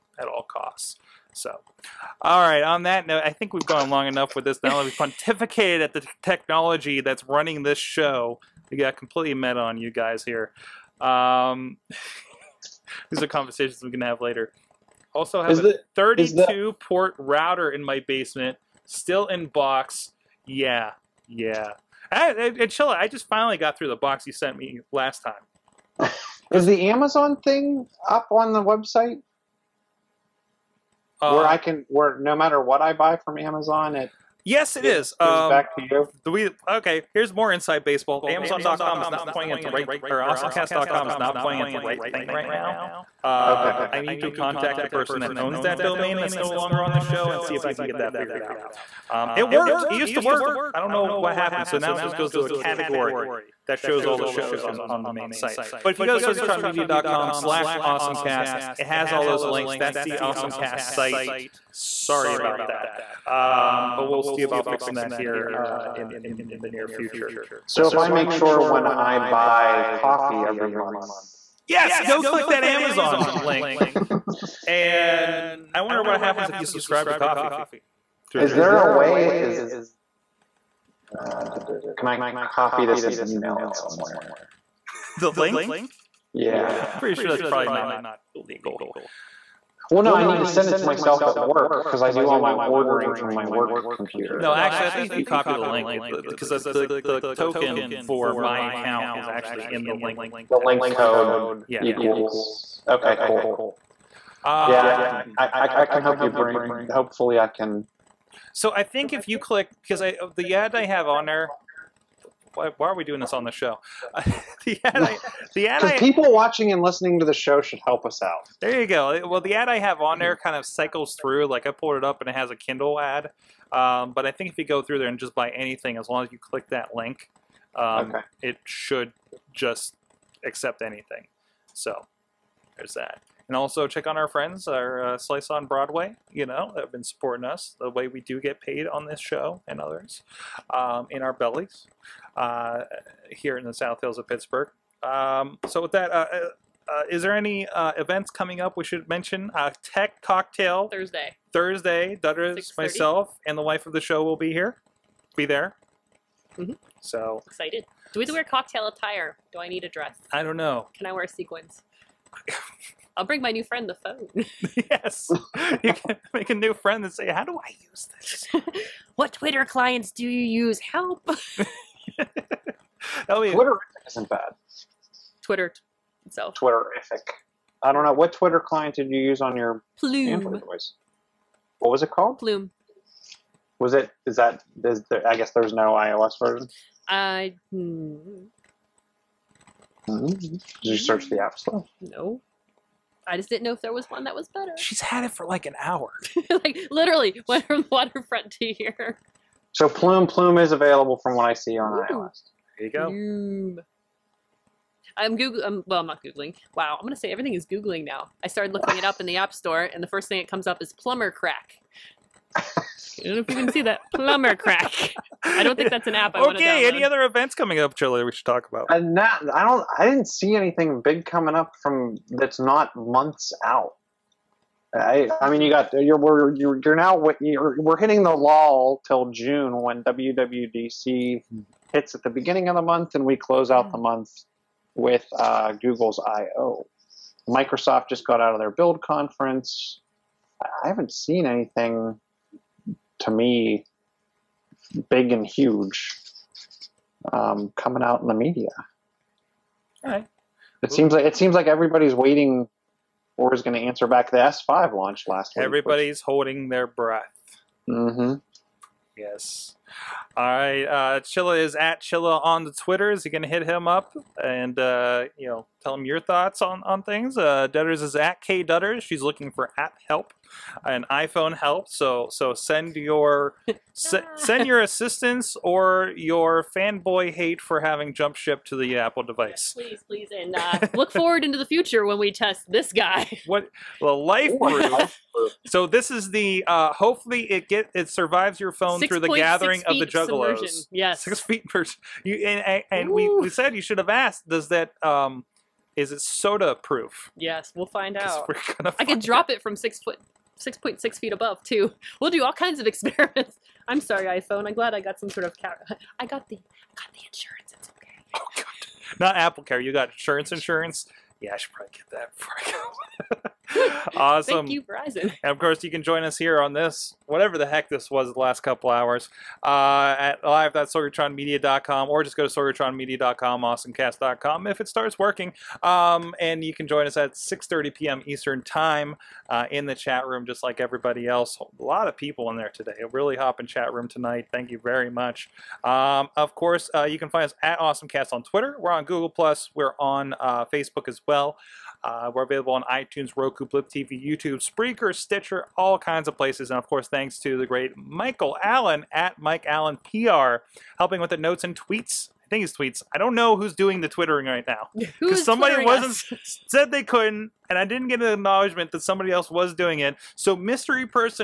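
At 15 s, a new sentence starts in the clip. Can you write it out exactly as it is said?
Also, have is a the, 32 the...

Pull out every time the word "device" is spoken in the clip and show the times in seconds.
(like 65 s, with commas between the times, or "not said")
180 s, 279 s.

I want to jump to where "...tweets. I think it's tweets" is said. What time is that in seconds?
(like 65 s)
351 s.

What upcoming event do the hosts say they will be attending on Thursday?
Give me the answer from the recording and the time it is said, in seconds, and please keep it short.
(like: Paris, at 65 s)
Tech Cocktail, at 149 s.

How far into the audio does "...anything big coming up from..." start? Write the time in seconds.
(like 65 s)
220 s.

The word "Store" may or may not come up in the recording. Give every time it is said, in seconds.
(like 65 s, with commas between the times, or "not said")
191 s, 209 s.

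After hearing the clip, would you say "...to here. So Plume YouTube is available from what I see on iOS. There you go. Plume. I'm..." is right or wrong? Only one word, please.
wrong.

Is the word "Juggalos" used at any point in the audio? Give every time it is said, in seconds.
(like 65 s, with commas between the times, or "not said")
290 s.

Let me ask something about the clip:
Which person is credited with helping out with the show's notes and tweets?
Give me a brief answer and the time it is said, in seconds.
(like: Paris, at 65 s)
Michael Allen, at 347 s.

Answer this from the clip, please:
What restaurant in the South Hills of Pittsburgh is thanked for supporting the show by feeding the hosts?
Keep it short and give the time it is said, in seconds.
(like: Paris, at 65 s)
Slice on Broadway, at 135 s.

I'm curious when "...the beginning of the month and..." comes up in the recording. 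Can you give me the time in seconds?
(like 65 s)
232 s.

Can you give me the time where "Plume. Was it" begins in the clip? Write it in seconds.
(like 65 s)
182 s.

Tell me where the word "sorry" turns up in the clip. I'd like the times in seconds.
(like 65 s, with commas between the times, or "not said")
61 s, 303 s.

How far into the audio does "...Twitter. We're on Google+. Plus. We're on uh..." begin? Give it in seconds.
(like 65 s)
338 s.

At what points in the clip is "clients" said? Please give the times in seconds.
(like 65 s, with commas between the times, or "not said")
169 s, 178 s.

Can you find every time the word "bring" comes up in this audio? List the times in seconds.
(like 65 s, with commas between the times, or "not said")
106 s, 163 s.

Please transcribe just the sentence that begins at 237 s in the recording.
Microsoft just got out of their Build conference.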